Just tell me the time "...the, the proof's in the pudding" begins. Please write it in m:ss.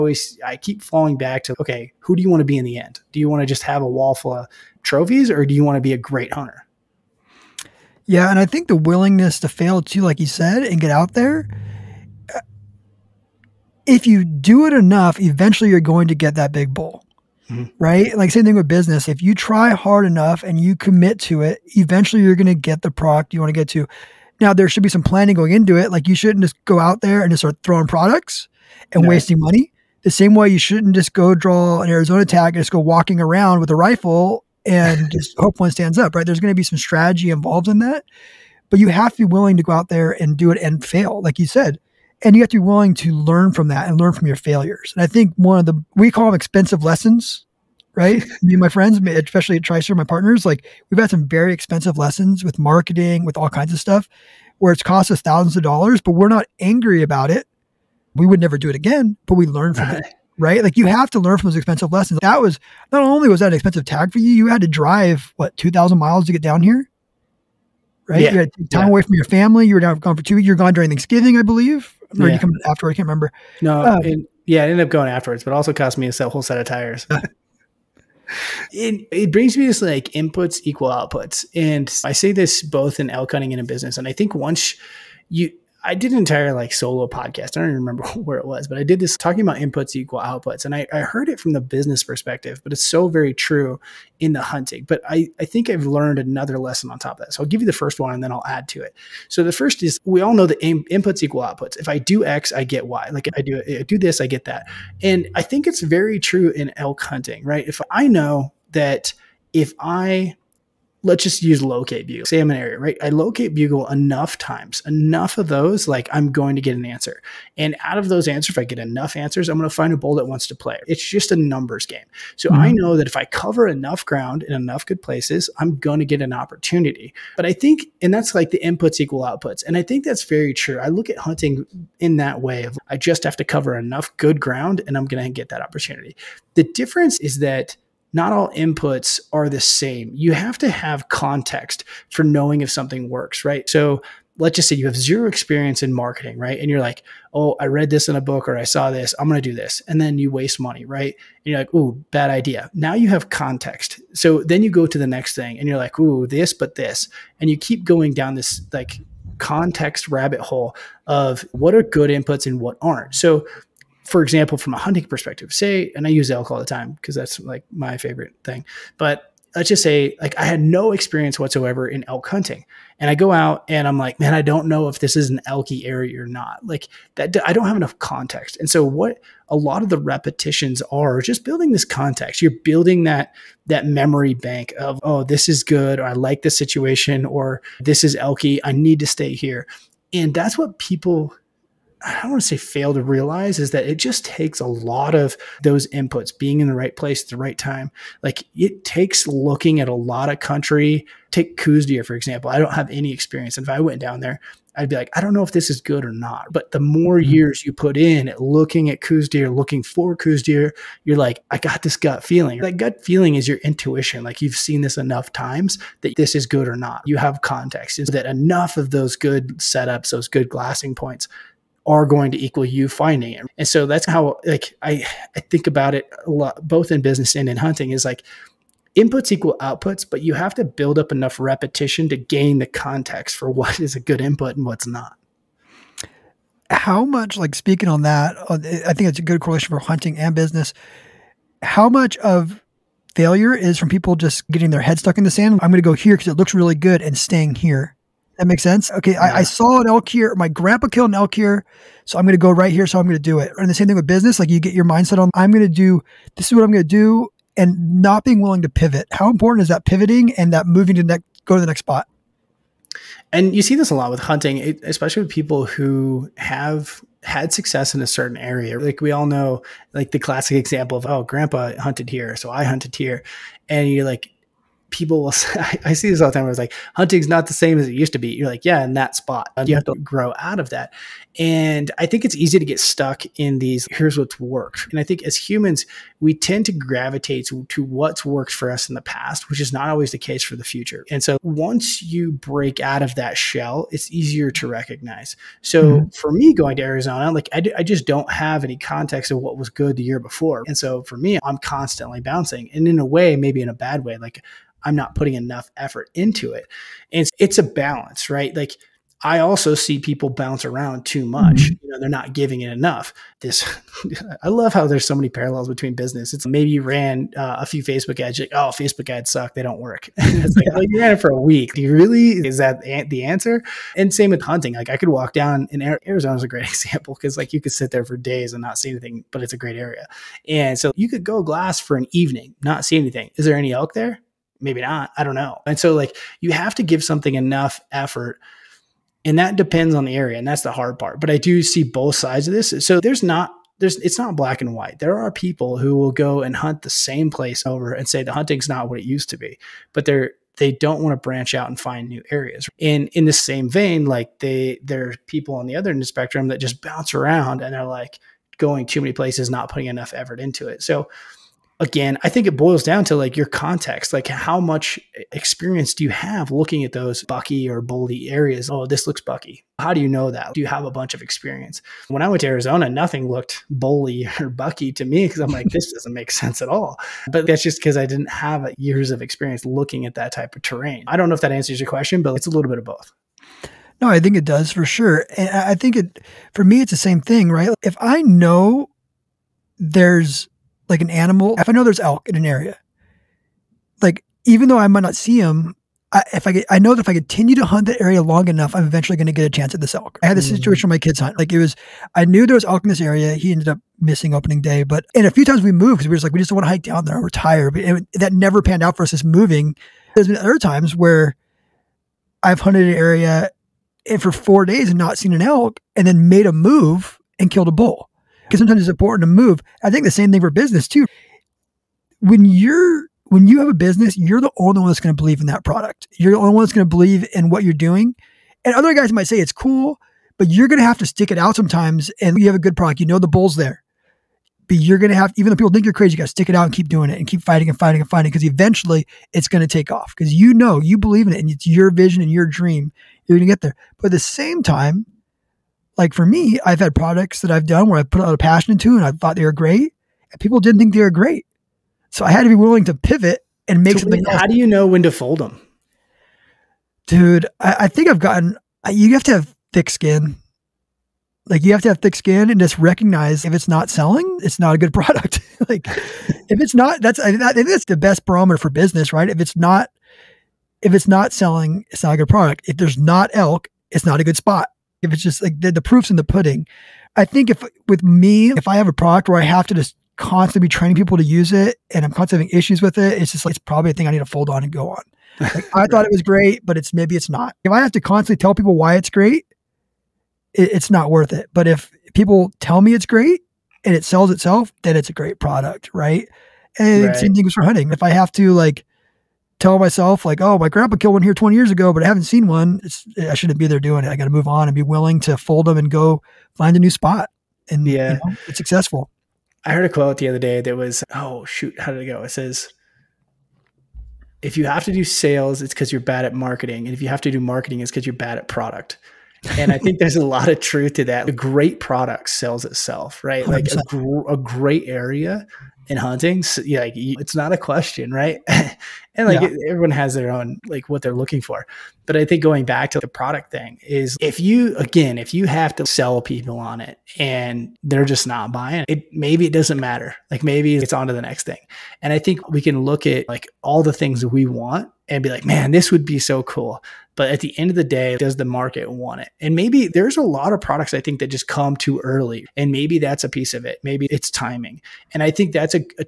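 7:55.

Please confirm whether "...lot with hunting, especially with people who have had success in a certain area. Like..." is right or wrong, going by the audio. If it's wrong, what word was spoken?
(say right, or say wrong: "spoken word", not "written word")
right.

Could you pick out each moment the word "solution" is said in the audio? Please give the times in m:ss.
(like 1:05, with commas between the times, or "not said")
not said.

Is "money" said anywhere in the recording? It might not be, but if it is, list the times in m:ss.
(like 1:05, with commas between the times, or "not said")
0:29, 2:30.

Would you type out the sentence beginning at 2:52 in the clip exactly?
And I go out and I'm like, man, I don't know if this is an elky area or not.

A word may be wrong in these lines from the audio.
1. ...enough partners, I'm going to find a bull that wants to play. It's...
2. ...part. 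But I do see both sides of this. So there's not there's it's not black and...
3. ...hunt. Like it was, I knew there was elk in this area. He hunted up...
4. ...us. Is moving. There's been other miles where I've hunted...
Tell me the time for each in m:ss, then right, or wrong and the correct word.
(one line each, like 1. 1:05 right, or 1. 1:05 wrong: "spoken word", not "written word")
1. 1:58 wrong: "answers", not "partners"
2. 5:40 right
3. 6:41 wrong: "ended", not "hunted"
4. 6:49 wrong: "times", not "miles".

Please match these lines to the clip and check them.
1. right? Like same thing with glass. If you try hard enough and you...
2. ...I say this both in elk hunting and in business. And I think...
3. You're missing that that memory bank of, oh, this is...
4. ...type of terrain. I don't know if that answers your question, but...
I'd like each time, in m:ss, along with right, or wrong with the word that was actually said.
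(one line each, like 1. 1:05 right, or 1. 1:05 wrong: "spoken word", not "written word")
1. 0:17 wrong: "business", not "glass"
2. 1:22 right
3. 3:02 wrong: "building", not "missing"
4. 6:20 right.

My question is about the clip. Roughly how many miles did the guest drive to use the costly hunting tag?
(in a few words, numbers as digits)
2000.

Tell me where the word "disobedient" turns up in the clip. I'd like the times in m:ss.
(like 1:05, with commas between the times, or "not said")
not said.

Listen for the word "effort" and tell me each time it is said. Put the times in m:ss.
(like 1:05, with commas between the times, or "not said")
5:05, 5:37, 6:00.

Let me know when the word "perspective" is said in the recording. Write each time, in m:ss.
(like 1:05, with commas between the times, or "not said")
1:32, 2:45.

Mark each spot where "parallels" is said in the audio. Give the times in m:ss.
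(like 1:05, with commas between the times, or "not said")
5:15.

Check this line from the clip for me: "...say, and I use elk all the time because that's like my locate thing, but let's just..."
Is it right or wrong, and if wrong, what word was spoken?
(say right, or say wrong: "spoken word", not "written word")
wrong: "favorite", not "locate".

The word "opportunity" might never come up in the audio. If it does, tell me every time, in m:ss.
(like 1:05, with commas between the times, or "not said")
2:06, 2:15.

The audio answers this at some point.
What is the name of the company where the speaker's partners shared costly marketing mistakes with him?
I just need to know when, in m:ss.
0:49.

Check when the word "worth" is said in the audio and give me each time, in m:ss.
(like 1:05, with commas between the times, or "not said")
8:11.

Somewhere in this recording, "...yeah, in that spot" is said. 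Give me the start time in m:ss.
4:38.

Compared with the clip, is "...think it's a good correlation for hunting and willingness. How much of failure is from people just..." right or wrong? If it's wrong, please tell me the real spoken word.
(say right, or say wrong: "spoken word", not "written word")
wrong: "business", not "willingness".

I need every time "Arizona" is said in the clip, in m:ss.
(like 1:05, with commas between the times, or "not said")
0:31, 4:56, 5:25, 6:12.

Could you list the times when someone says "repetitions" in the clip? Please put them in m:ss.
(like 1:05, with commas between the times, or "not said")
2:59, 3:51.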